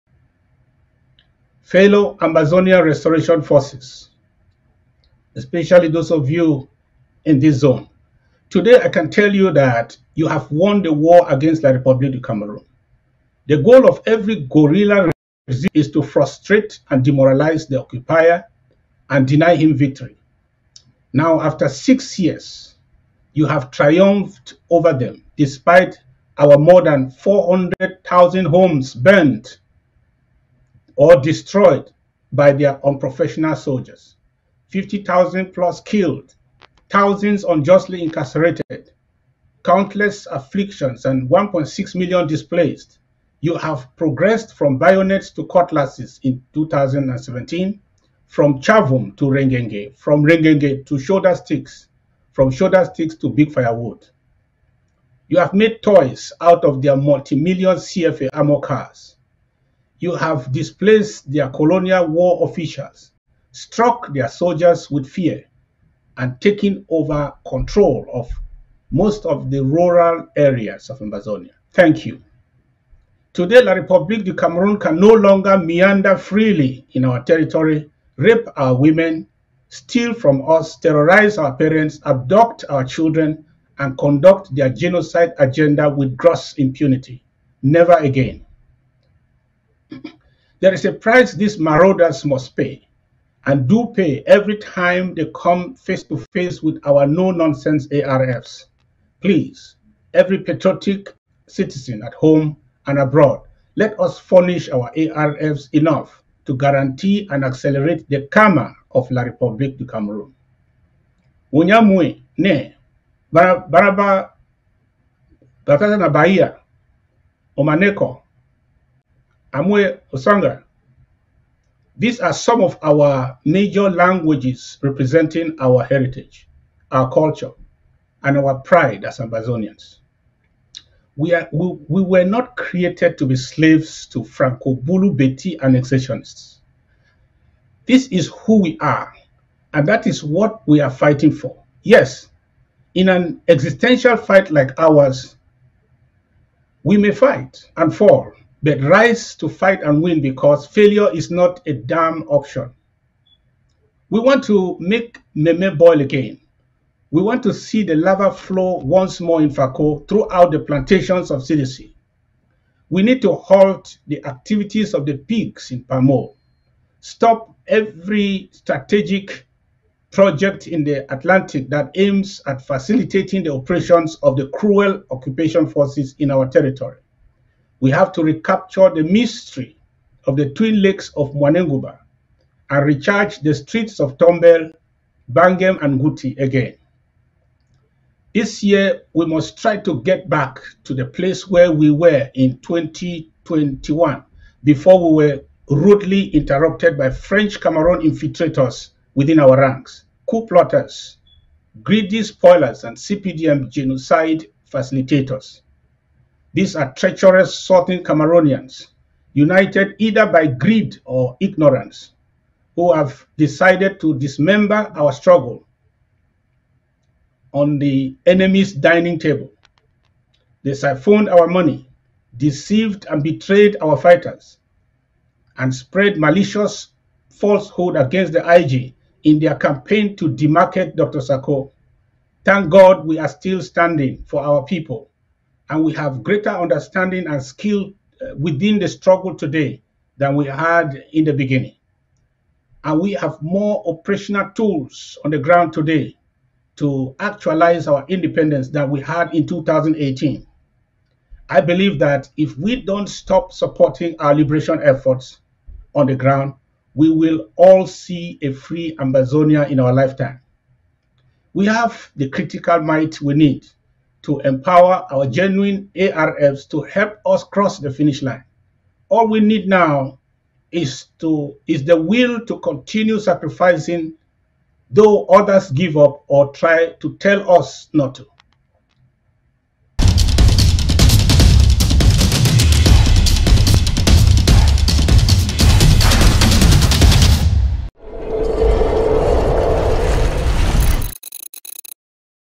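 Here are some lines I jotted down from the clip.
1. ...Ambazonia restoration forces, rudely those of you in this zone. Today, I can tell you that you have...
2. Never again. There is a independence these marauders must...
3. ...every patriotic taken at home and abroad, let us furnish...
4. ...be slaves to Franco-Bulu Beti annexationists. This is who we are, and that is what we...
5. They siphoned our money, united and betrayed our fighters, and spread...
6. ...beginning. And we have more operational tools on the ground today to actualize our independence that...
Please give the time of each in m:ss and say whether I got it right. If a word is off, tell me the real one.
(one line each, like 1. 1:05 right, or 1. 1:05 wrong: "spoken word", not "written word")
1. 0:02 wrong: "especially", not "rudely"
2. 1:27 wrong: "price", not "independence"
3. 1:40 wrong: "citizen", not "taken"
4. 2:13 right
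5. 3:40 wrong: "deceived", not "united"
6. 4:01 right.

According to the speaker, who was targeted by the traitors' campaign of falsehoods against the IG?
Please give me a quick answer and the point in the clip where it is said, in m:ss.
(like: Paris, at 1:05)
Dr. Sako, at 3:50.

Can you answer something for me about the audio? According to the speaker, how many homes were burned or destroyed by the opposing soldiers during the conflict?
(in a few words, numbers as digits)
400,000.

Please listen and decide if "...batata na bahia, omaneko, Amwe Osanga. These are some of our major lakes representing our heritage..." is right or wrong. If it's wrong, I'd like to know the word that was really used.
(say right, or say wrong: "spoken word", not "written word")
wrong: "languages", not "lakes".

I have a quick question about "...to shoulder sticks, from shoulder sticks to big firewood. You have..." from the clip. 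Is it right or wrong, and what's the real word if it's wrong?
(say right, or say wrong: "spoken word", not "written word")
right.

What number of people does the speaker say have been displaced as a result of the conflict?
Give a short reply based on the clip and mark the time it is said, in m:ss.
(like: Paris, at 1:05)
1.6 million, at 0:41.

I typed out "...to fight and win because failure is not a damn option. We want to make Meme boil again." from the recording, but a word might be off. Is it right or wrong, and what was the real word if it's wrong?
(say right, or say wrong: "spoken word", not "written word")
right.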